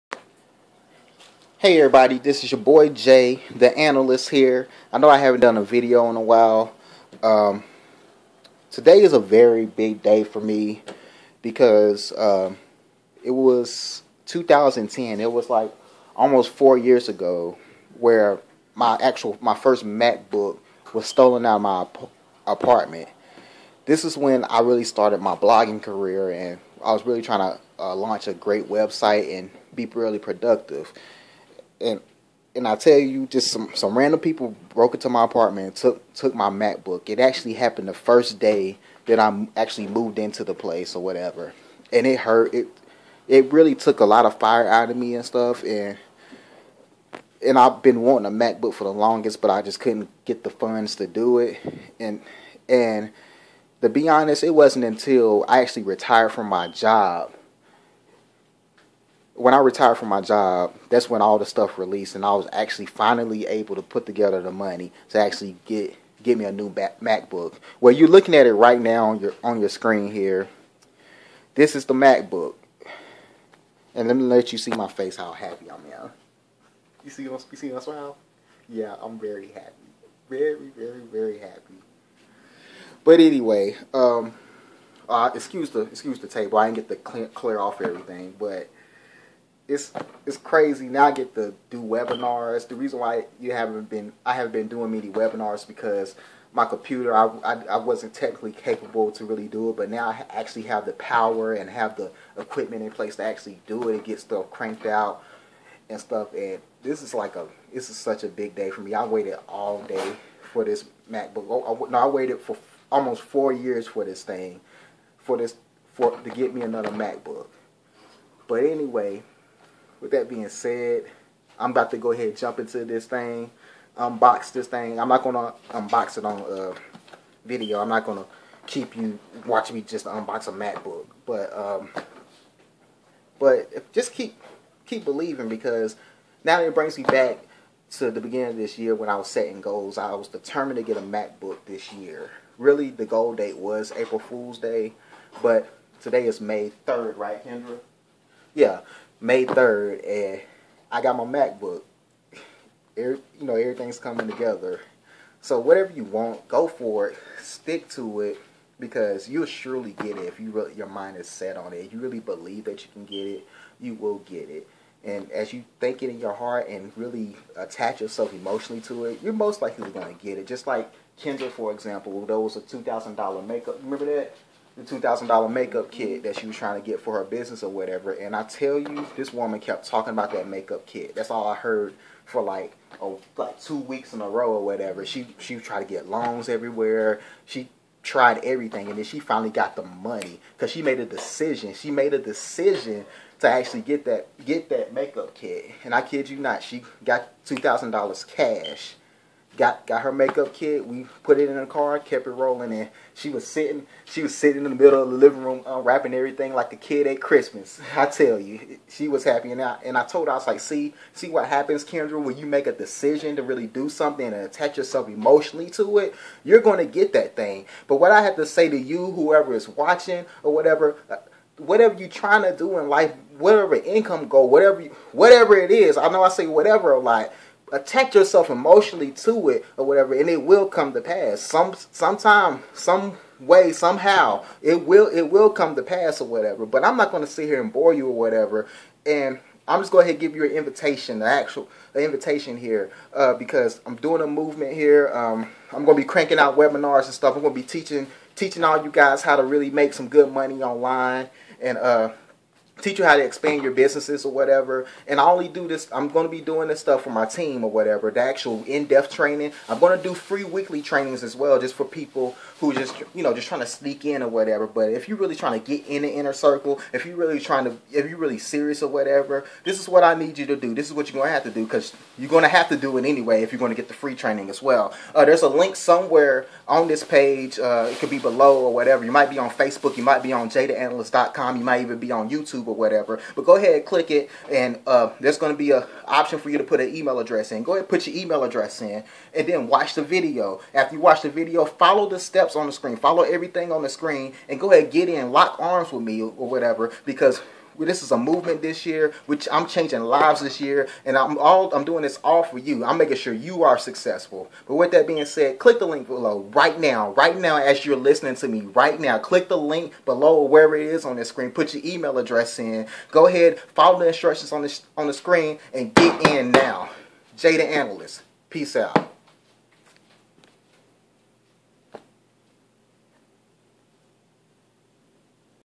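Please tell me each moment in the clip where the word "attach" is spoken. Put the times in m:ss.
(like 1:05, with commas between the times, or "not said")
2:47, 3:34, 3:47.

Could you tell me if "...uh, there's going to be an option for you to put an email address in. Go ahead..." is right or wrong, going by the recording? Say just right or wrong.
right.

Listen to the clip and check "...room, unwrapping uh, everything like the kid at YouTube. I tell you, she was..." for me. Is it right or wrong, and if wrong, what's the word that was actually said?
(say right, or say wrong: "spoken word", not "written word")
wrong: "Christmas", not "YouTube".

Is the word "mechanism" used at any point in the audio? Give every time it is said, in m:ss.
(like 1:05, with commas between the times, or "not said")
not said.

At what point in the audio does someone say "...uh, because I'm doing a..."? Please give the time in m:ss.
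4:03.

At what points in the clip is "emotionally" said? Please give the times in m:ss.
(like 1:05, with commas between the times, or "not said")
2:48, 3:35, 3:48.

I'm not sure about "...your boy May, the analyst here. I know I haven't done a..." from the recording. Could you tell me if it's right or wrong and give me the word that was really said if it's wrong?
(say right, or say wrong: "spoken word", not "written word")
wrong: "Jay", not "May".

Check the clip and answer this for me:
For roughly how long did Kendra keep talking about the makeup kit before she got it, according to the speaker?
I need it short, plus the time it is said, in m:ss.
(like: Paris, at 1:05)
two weeks, at 3:03.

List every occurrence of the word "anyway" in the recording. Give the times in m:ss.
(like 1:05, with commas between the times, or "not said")
1:23, 1:58, 4:33.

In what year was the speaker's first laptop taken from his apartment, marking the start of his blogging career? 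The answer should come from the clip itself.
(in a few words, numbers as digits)
2010.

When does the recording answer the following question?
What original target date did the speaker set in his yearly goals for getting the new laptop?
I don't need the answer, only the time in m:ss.
2:23.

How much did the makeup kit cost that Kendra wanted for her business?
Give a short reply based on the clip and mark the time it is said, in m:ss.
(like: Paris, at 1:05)
$2,000, at 2:52.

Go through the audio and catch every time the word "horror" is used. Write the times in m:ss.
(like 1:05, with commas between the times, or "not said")
not said.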